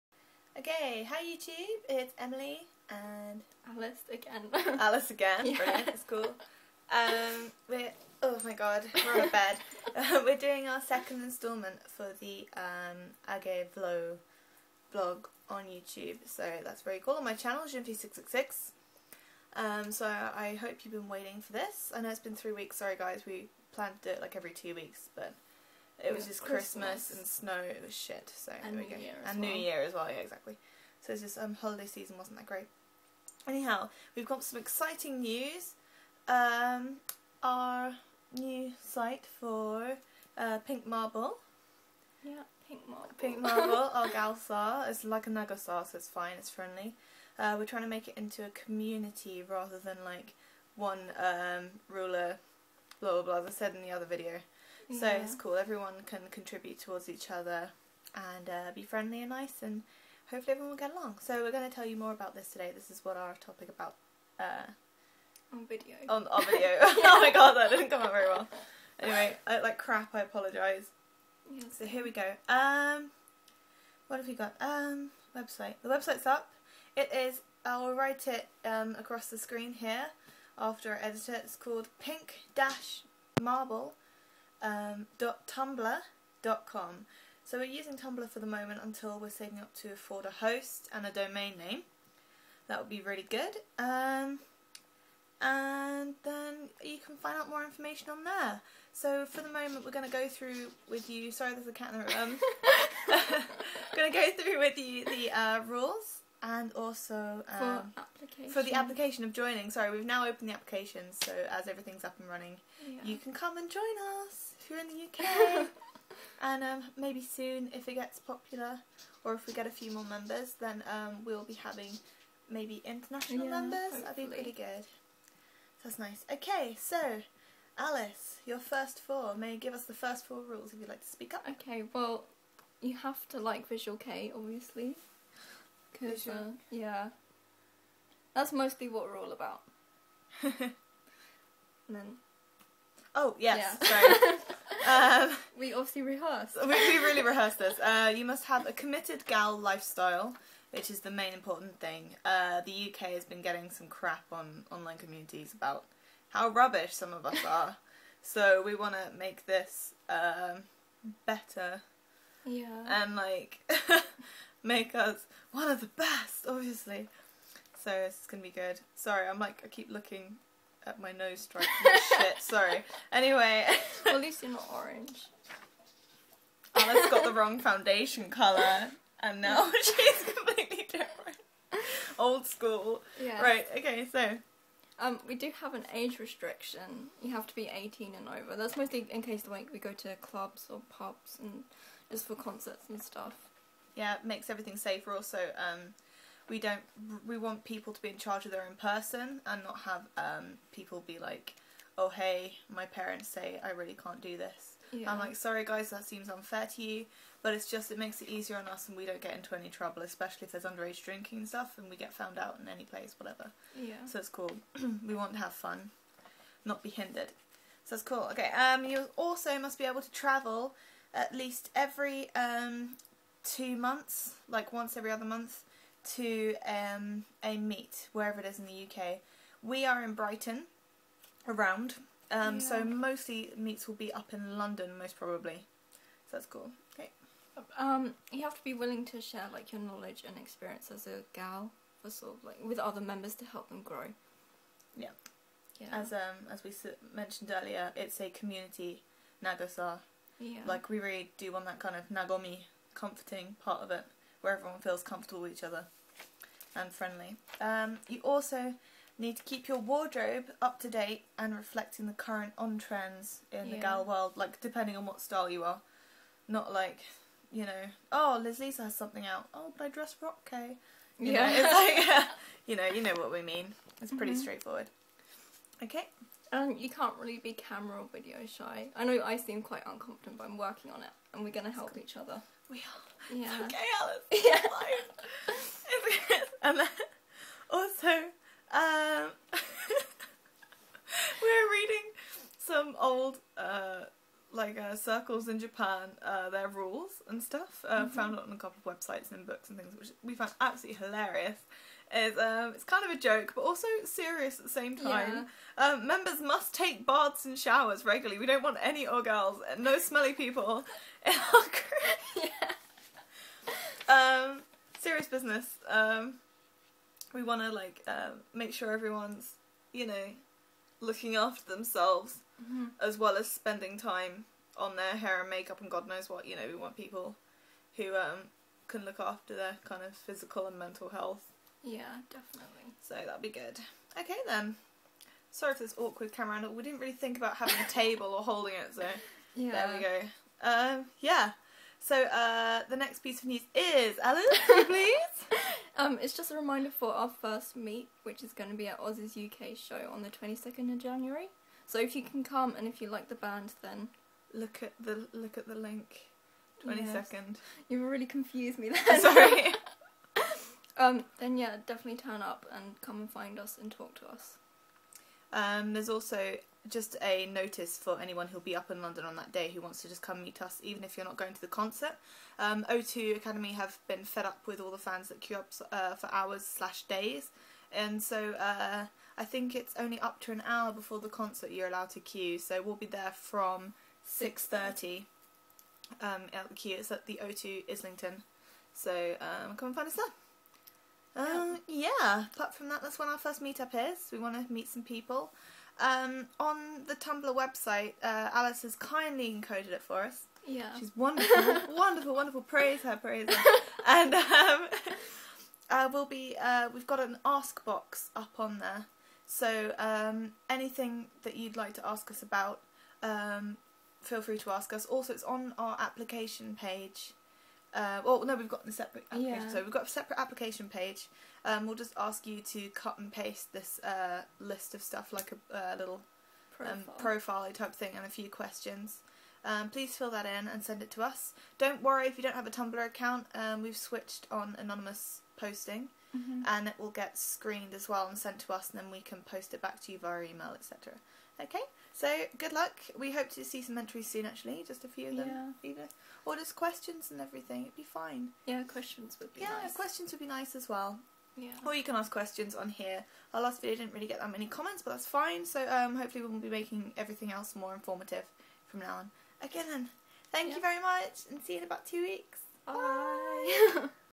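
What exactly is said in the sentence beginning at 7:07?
Um, type thing, and a few questions.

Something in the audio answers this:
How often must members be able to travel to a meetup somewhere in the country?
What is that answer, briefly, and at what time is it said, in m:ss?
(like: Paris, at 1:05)
Once every other month, at 3:44.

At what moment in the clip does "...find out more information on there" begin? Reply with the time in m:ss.
1:37.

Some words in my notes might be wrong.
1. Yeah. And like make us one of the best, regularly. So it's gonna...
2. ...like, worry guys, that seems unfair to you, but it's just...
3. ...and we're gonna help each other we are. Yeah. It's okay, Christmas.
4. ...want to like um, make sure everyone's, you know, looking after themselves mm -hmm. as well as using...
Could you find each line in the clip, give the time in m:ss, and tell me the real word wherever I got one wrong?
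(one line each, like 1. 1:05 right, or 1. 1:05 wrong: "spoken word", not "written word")
1. 2:42 wrong: "obviously", not "regularly"
2. 3:25 wrong: "sorry", not "worry"
3. 4:41 wrong: "Alice", not "Christmas"
4. 5:17 wrong: "spending", not "using".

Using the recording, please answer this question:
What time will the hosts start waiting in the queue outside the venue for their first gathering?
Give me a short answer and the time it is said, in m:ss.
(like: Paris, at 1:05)
6:30, at 6:24.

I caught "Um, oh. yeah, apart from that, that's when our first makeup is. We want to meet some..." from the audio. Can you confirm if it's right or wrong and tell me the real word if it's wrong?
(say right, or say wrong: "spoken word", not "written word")
wrong: "meetup", not "makeup".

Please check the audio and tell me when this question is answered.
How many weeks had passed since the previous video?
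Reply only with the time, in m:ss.
0:22.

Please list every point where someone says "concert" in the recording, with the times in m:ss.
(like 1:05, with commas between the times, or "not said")
3:12, 6:11, 6:21.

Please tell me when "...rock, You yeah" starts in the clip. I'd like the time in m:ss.
4:30.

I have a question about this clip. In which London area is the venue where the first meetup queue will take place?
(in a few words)
Islington.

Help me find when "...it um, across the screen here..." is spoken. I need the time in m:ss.
1:18.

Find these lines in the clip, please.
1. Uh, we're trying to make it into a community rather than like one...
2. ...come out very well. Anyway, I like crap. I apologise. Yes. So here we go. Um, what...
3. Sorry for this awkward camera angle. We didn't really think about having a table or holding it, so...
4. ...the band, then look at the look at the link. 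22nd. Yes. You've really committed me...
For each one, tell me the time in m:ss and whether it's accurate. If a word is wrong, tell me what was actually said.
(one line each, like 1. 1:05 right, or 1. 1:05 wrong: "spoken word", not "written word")
1. 0:47 right
2. 1:07 right
3. 5:35 right
4. 5:53 wrong: "confused", not "committed".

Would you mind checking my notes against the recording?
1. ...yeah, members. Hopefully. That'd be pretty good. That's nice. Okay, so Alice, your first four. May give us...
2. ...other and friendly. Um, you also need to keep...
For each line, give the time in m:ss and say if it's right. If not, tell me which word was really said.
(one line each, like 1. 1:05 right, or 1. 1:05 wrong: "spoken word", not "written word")
1. 2:03 right
2. 4:15 right.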